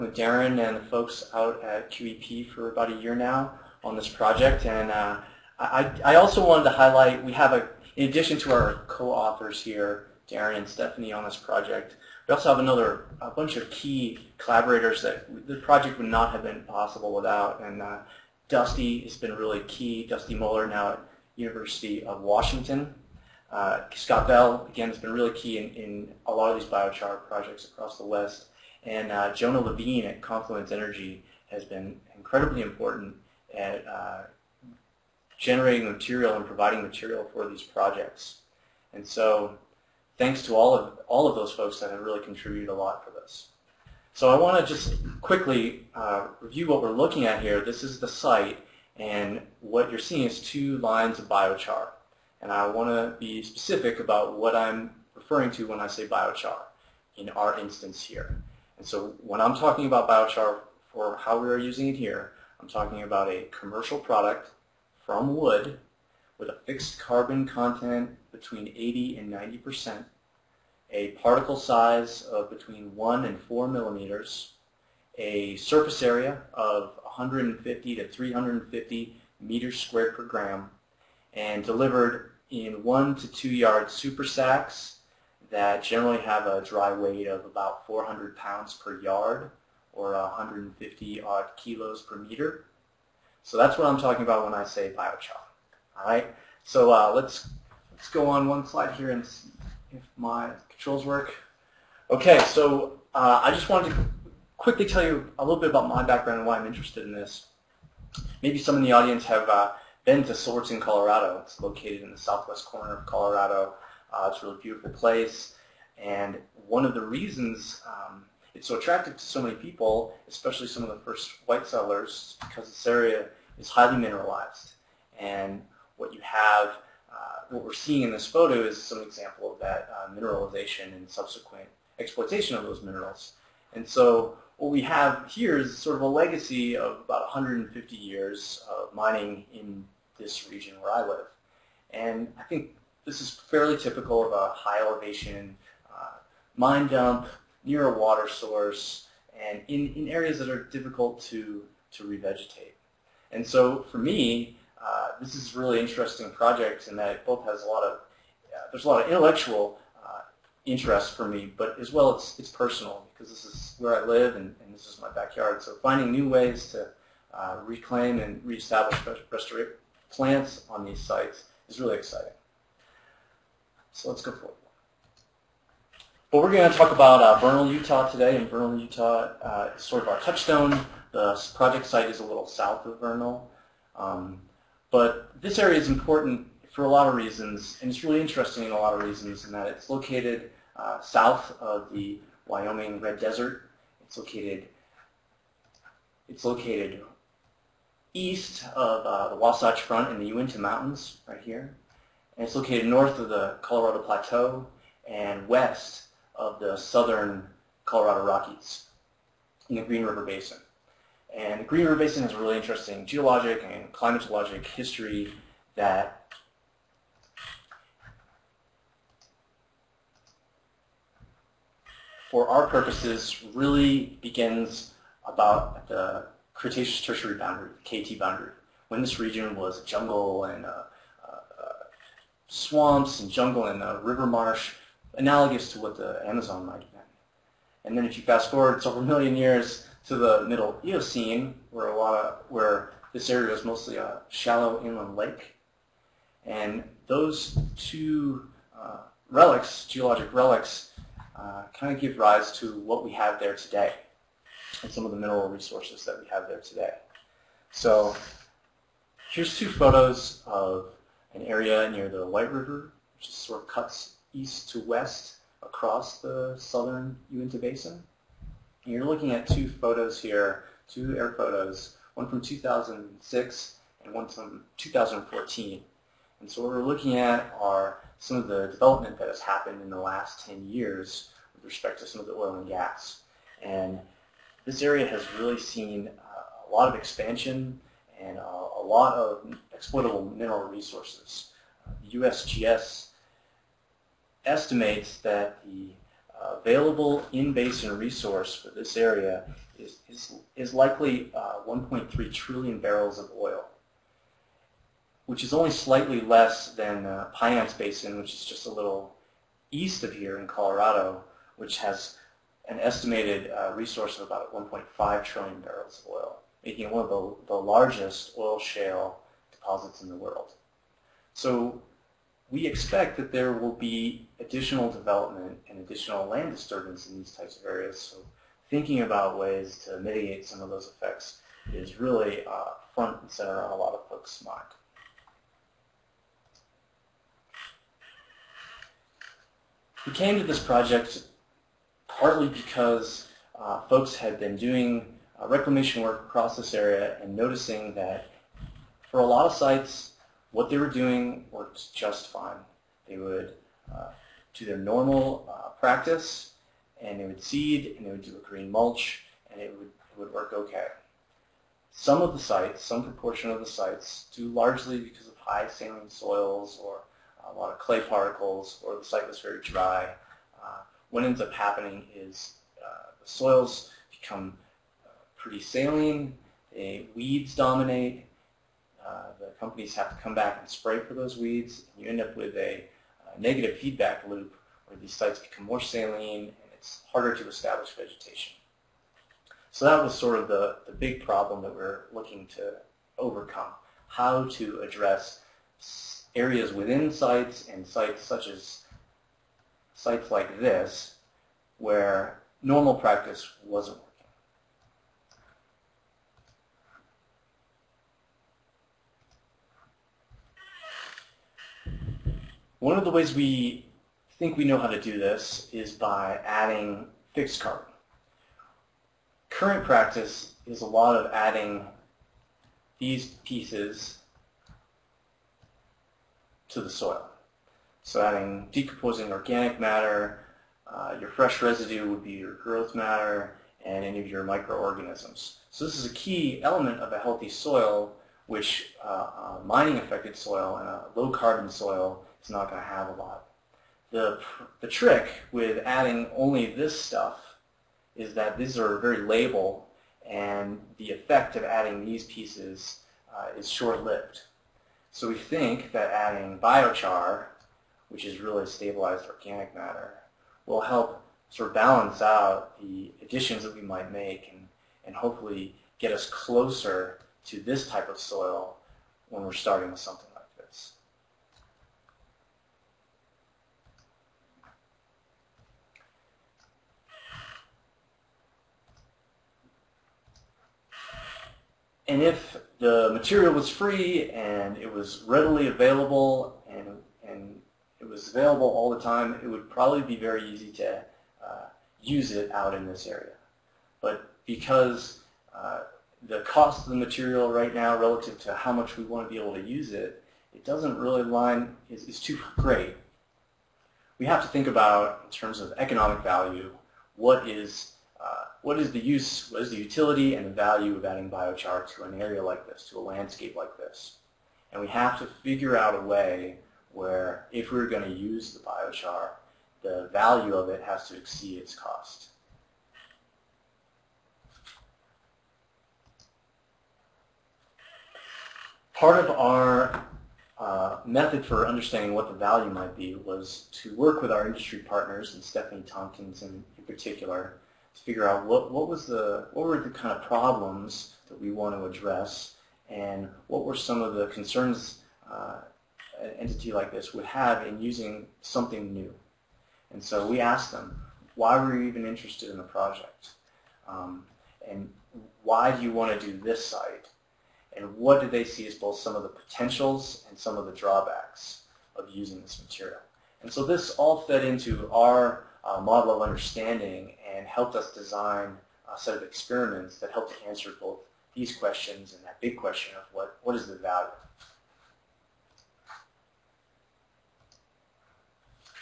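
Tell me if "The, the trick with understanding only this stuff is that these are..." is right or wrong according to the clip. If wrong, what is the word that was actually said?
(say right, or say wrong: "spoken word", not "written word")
wrong: "adding", not "understanding".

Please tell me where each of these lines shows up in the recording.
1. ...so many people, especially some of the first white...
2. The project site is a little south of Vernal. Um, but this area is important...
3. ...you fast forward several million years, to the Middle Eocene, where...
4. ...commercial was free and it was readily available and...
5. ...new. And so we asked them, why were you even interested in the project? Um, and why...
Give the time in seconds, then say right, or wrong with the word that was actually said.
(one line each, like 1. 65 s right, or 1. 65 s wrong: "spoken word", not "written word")
1. 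119 s right
2. 181 s right
3. 238 s right
4. 483 s wrong: "material", not "commercial"
5. 548 s right.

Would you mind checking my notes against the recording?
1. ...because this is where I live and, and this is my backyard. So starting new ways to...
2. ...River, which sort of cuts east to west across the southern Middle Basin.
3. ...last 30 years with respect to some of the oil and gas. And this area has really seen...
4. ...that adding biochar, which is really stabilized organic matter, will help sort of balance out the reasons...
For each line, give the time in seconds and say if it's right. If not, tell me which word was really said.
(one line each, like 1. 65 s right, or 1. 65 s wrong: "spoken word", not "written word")
1. 163 s wrong: "finding", not "starting"
2. 262 s wrong: "Uinta", not "Middle"
3. 279 s wrong: "10", not "30"
4. 455 s wrong: "additions", not "reasons".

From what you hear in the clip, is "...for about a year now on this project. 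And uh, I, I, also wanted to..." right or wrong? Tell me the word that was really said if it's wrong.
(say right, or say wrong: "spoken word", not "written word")
right.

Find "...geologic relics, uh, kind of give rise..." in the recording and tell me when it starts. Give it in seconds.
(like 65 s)
249 s.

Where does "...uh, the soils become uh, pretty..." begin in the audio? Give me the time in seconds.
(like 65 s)
372 s.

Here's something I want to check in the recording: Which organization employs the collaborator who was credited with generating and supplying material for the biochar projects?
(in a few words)
Confluence Energy.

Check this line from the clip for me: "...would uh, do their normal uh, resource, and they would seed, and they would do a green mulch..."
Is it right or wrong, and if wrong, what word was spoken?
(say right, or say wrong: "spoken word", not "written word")
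wrong: "practice", not "resource".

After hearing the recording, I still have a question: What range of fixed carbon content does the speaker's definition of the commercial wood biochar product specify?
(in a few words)
80 to 90 percent.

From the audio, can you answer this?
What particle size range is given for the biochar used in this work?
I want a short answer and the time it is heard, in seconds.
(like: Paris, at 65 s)
1 to 4 millimeters, at 72 s.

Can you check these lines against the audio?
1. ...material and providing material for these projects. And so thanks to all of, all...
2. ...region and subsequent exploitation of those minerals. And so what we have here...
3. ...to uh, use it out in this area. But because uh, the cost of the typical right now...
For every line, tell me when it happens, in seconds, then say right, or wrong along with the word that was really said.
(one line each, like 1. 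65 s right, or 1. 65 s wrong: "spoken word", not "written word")
1. 35 s right
2. 130 s wrong: "mineralization", not "region"
3. 490 s wrong: "material", not "typical".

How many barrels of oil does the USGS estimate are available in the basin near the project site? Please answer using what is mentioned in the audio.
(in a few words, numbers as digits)
1.3 trillion.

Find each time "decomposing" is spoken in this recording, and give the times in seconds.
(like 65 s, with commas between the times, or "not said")
428 s.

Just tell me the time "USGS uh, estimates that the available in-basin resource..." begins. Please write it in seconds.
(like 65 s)
292 s.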